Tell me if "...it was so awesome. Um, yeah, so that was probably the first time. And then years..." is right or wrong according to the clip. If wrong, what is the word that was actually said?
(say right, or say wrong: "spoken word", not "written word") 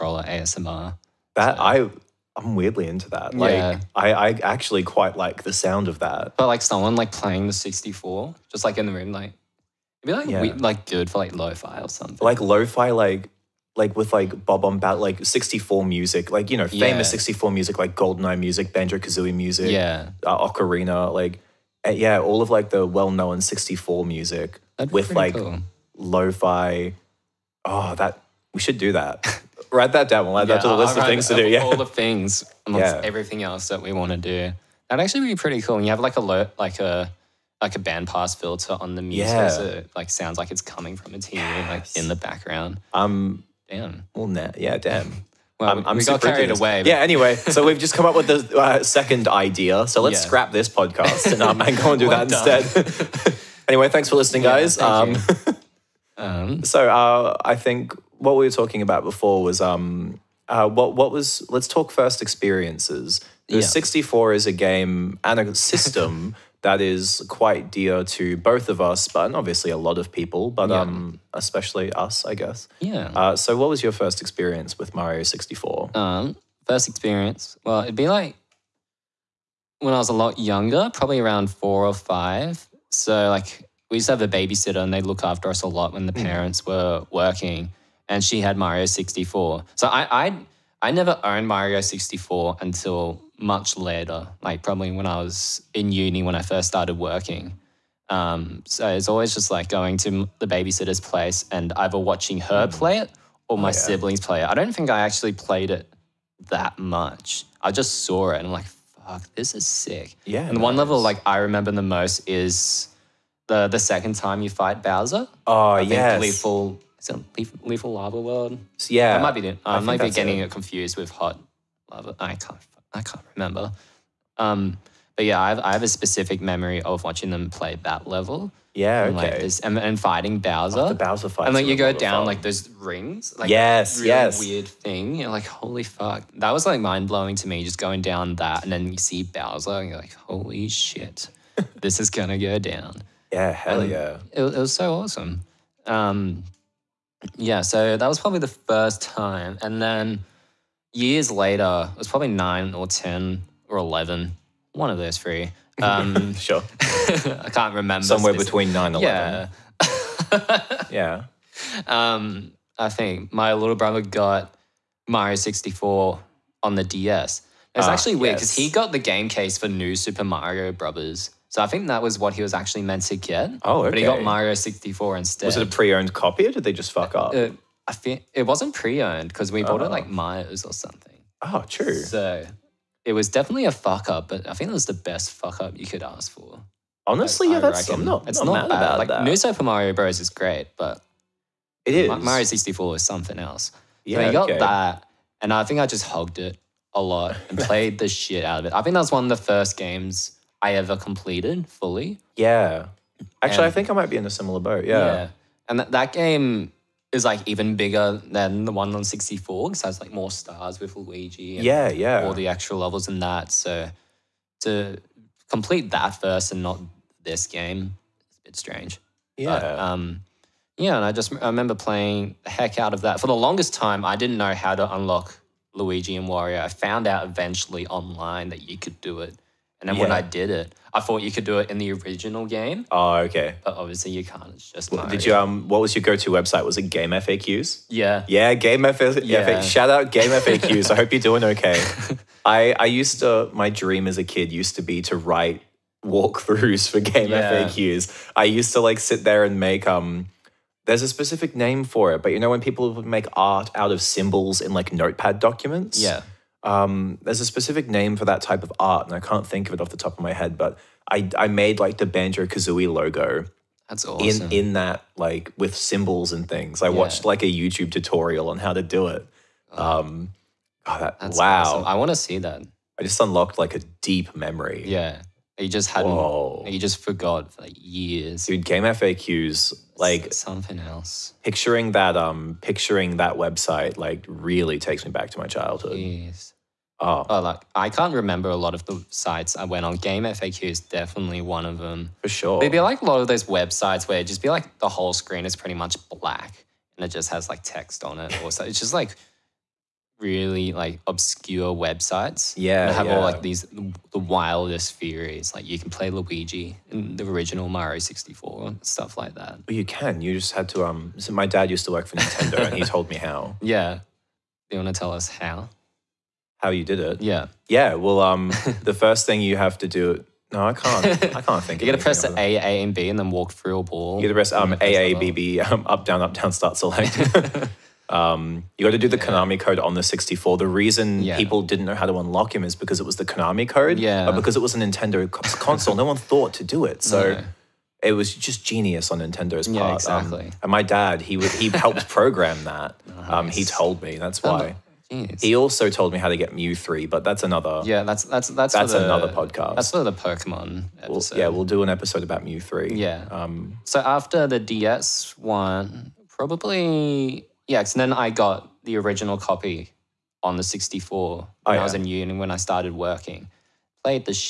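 right.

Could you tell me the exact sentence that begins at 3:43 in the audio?
For the longest time, I didn't know how to unlock Luigi and Wario.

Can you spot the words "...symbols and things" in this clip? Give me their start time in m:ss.
4:25.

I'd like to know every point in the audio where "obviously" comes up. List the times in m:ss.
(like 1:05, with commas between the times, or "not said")
1:09, 3:53.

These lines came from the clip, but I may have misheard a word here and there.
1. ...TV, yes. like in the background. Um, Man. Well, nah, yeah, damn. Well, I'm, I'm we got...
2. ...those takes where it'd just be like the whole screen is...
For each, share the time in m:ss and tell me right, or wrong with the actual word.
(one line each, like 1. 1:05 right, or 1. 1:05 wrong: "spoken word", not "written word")
1. 0:41 right
2. 4:53 wrong: "websites", not "takes".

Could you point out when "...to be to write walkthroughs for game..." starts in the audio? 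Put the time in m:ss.
4:04.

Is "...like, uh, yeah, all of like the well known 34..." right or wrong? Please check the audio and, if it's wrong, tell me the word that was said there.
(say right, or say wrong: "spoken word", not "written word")
wrong: "64", not "34".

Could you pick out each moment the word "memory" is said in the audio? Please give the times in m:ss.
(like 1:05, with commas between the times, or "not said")
2:06, 4:34.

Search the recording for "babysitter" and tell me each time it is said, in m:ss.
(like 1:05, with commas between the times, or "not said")
1:24, 1:40.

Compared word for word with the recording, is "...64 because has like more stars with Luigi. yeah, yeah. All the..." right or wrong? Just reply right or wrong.
right.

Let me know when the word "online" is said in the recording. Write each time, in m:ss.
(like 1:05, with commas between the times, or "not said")
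3:47.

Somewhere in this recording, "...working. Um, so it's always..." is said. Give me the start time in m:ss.
1:36.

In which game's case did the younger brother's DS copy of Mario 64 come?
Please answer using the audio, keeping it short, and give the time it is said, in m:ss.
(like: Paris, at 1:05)
New Super Mario Brothers, at 2:49.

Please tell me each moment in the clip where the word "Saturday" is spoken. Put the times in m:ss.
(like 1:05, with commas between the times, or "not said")
not said.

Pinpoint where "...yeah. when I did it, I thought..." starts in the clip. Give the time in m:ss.
3:49.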